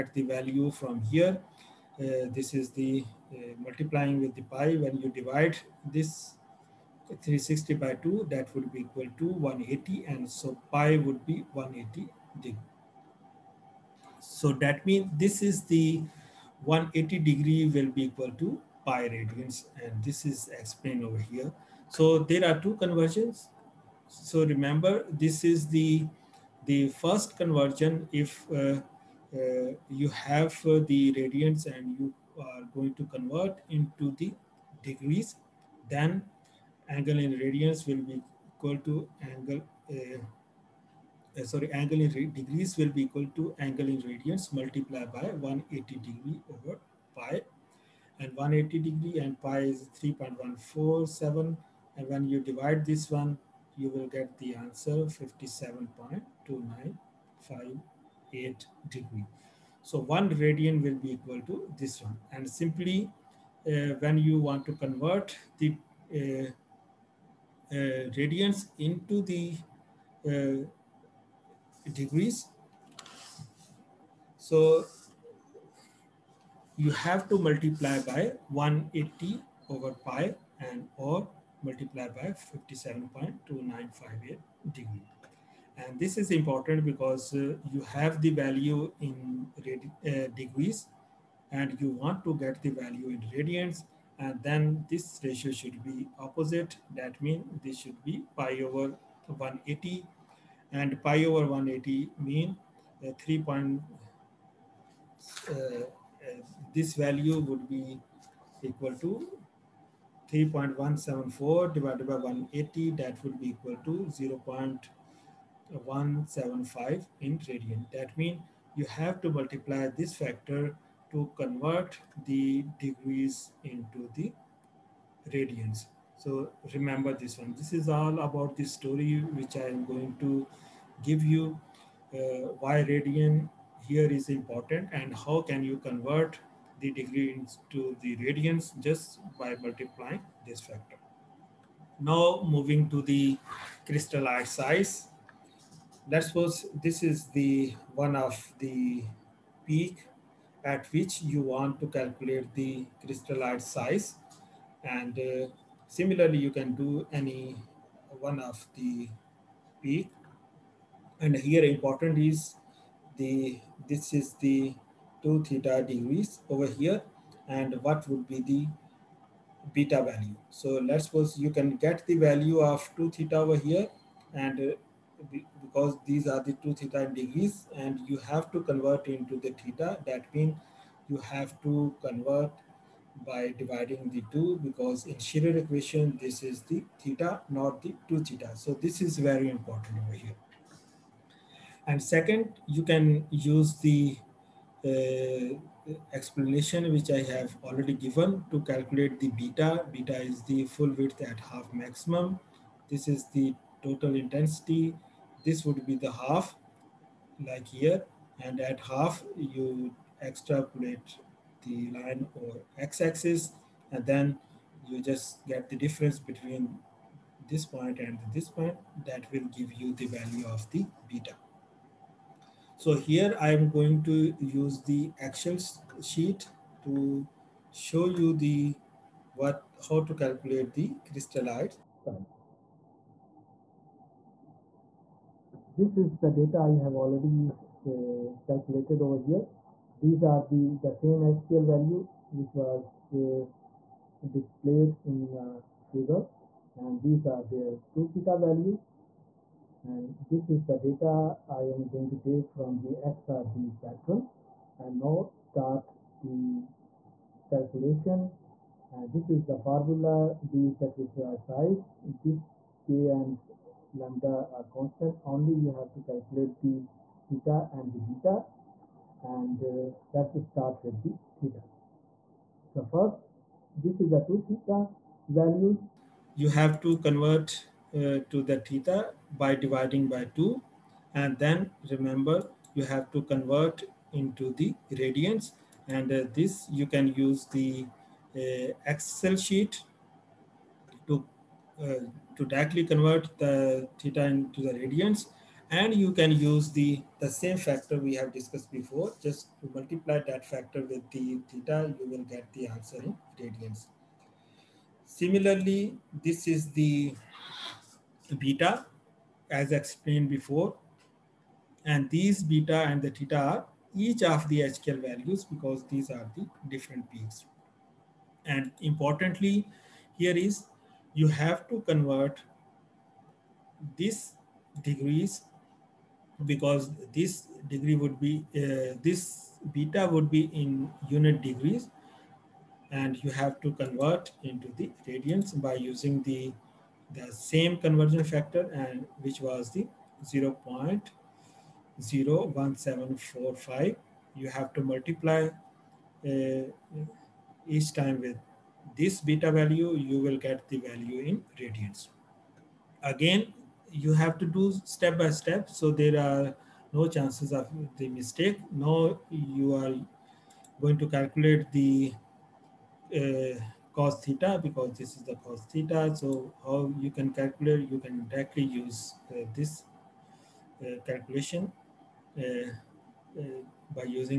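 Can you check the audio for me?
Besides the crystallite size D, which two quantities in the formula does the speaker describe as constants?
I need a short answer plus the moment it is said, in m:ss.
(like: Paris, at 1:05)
K and lambda, at 4:22.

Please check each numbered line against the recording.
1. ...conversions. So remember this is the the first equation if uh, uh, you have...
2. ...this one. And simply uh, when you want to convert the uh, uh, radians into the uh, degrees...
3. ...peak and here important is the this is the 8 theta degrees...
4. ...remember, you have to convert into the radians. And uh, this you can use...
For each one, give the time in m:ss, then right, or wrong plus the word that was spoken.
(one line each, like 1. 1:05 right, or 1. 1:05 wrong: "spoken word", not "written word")
1. 0:22 wrong: "conversion", not "equation"
2. 1:01 right
3. 2:39 wrong: "2", not "8"
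4. 4:41 right.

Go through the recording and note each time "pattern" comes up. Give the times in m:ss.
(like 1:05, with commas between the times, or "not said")
4:13.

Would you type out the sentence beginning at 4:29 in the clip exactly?
And uh, let's start with the theta.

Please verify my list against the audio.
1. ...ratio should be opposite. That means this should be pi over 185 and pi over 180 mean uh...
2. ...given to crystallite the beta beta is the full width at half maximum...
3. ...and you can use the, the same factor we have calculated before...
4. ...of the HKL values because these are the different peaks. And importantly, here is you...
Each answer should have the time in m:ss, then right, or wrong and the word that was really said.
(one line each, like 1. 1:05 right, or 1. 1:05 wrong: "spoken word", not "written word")
1. 1:35 wrong: "180", not "185"
2. 3:17 wrong: "calculate", not "crystallite"
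3. 4:55 wrong: "discussed", not "calculated"
4. 5:14 right.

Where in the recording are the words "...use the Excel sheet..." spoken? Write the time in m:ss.
3:44.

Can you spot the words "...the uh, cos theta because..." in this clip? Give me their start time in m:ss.
6:01.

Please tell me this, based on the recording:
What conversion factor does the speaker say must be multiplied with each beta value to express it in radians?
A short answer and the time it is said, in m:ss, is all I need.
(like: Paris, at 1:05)
0.01745, at 5:40.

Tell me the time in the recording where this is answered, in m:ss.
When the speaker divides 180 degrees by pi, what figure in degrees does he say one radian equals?
0:55.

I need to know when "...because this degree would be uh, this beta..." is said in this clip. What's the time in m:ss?
5:26.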